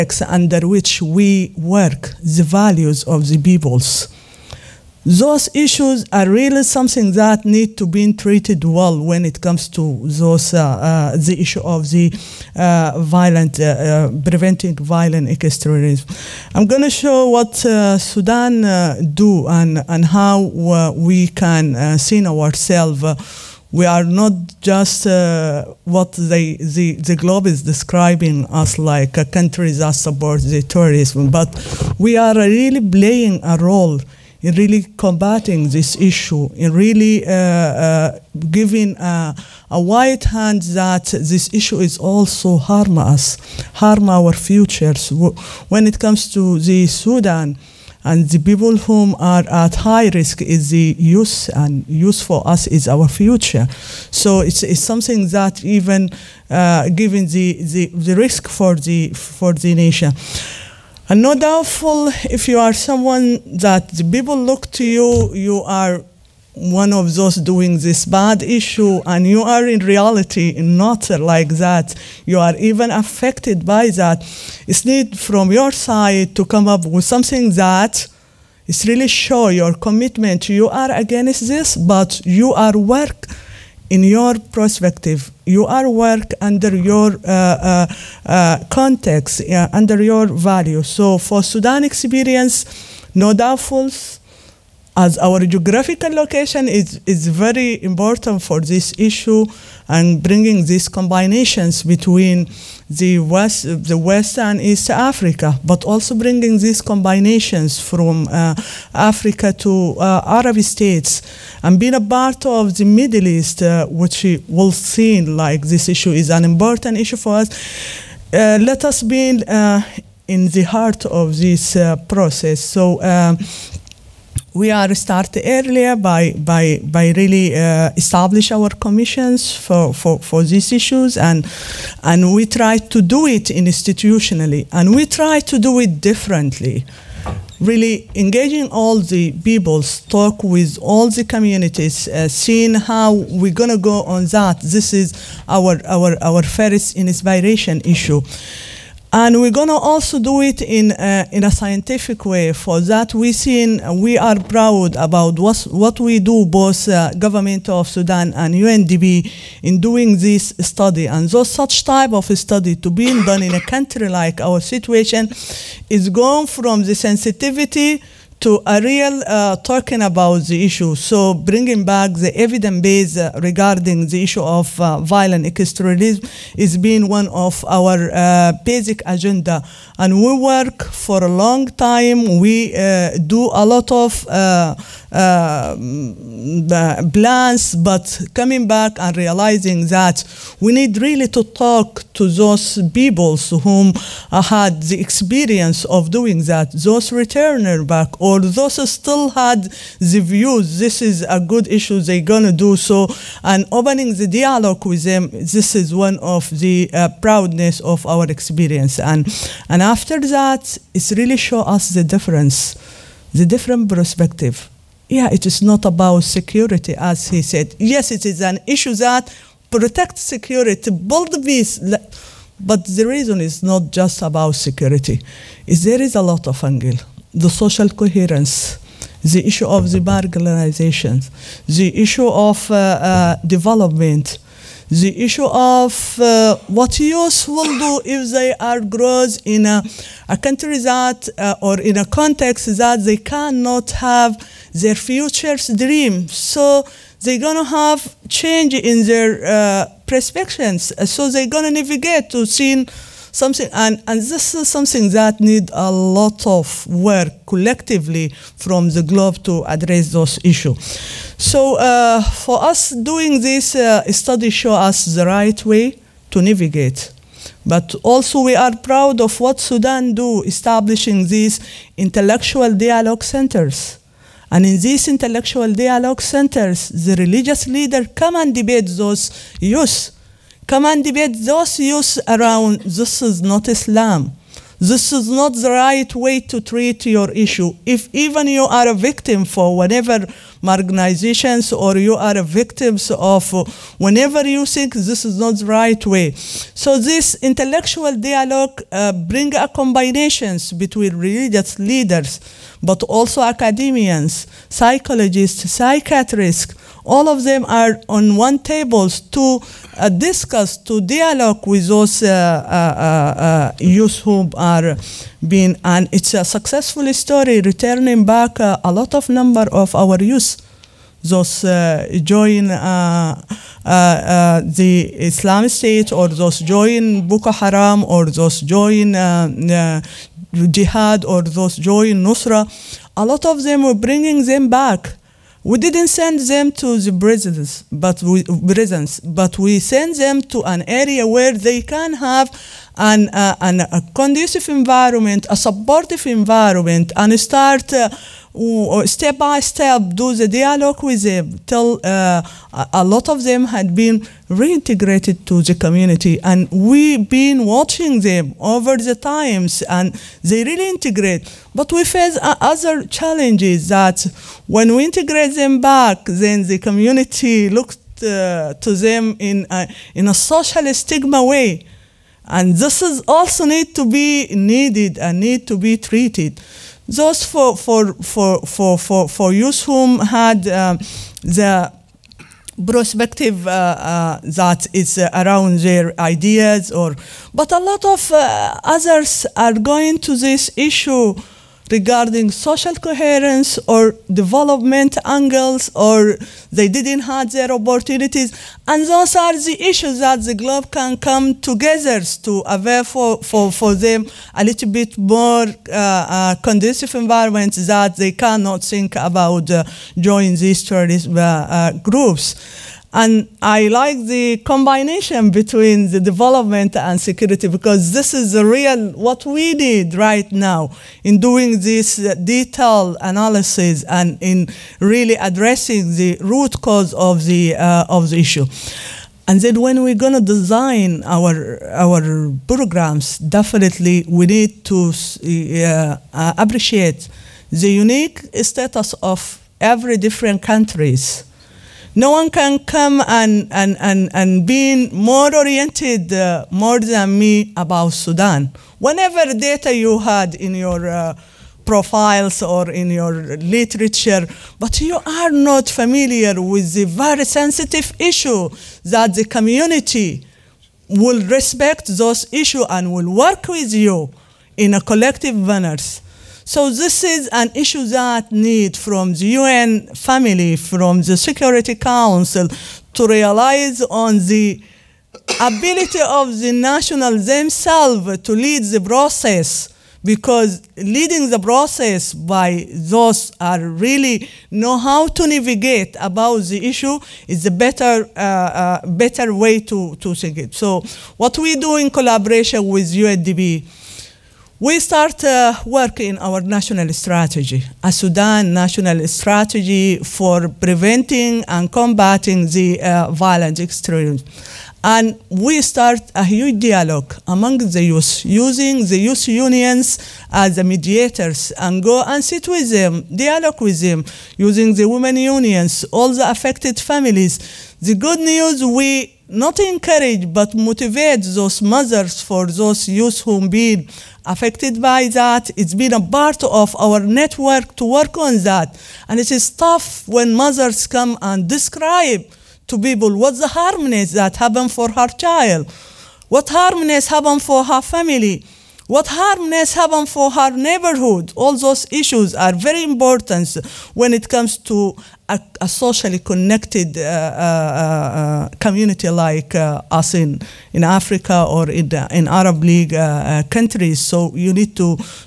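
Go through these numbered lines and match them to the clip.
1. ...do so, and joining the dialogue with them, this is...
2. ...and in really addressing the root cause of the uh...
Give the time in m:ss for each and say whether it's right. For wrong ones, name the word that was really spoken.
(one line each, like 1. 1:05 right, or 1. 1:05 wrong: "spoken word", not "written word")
1. 3:22 wrong: "opening", not "joining"
2. 7:04 right.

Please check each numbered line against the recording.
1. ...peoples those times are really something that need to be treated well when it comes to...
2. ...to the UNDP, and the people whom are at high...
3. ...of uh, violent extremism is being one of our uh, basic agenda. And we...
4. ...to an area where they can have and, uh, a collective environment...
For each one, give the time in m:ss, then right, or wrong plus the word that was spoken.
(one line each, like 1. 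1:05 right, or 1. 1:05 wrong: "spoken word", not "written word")
1. 0:03 wrong: "issues", not "times"
2. 0:46 wrong: "Sudan", not "UNDP"
3. 2:54 right
4. 5:40 wrong: "conducive", not "collective".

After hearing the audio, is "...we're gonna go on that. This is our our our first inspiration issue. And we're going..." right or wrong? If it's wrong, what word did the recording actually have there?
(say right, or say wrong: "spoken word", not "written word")
right.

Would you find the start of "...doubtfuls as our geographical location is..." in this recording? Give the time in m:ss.
1:33.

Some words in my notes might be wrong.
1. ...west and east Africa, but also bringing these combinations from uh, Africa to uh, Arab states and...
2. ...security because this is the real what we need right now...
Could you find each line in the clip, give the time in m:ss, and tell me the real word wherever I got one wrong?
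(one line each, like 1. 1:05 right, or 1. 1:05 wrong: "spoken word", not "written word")
1. 1:43 right
2. 6:57 right.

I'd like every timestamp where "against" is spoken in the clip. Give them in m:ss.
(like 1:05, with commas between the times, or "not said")
1:20.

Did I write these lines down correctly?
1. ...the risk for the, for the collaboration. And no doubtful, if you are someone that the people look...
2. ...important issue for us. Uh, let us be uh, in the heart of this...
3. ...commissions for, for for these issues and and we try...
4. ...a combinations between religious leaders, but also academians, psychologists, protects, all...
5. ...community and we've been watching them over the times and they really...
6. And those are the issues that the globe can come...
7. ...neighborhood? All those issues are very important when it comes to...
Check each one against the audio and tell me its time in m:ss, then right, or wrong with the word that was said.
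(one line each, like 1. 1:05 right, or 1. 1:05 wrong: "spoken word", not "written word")
1. 0:57 wrong: "nation", not "collaboration"
2. 1:56 right
3. 2:08 right
4. 4:59 wrong: "psychiatrists", not "protects"
5. 5:55 right
6. 6:38 right
7. 9:00 right.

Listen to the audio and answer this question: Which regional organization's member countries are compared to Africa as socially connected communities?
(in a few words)
Arab League.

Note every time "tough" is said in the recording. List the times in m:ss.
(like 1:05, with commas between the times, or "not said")
8:49.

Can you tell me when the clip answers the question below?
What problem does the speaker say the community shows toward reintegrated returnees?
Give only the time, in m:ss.
6:10.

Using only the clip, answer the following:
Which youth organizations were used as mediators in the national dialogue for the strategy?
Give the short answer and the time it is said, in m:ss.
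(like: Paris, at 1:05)
youth unions, at 8:29.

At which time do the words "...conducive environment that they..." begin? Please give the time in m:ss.
6:46.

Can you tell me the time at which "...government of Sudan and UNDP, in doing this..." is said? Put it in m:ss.
2:37.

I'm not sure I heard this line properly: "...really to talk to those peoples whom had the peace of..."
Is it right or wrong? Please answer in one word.
wrong.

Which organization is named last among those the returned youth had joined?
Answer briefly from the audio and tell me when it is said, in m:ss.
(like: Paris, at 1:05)
Nusra, at 5:32.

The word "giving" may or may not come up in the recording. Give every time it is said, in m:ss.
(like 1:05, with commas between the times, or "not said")
0:38.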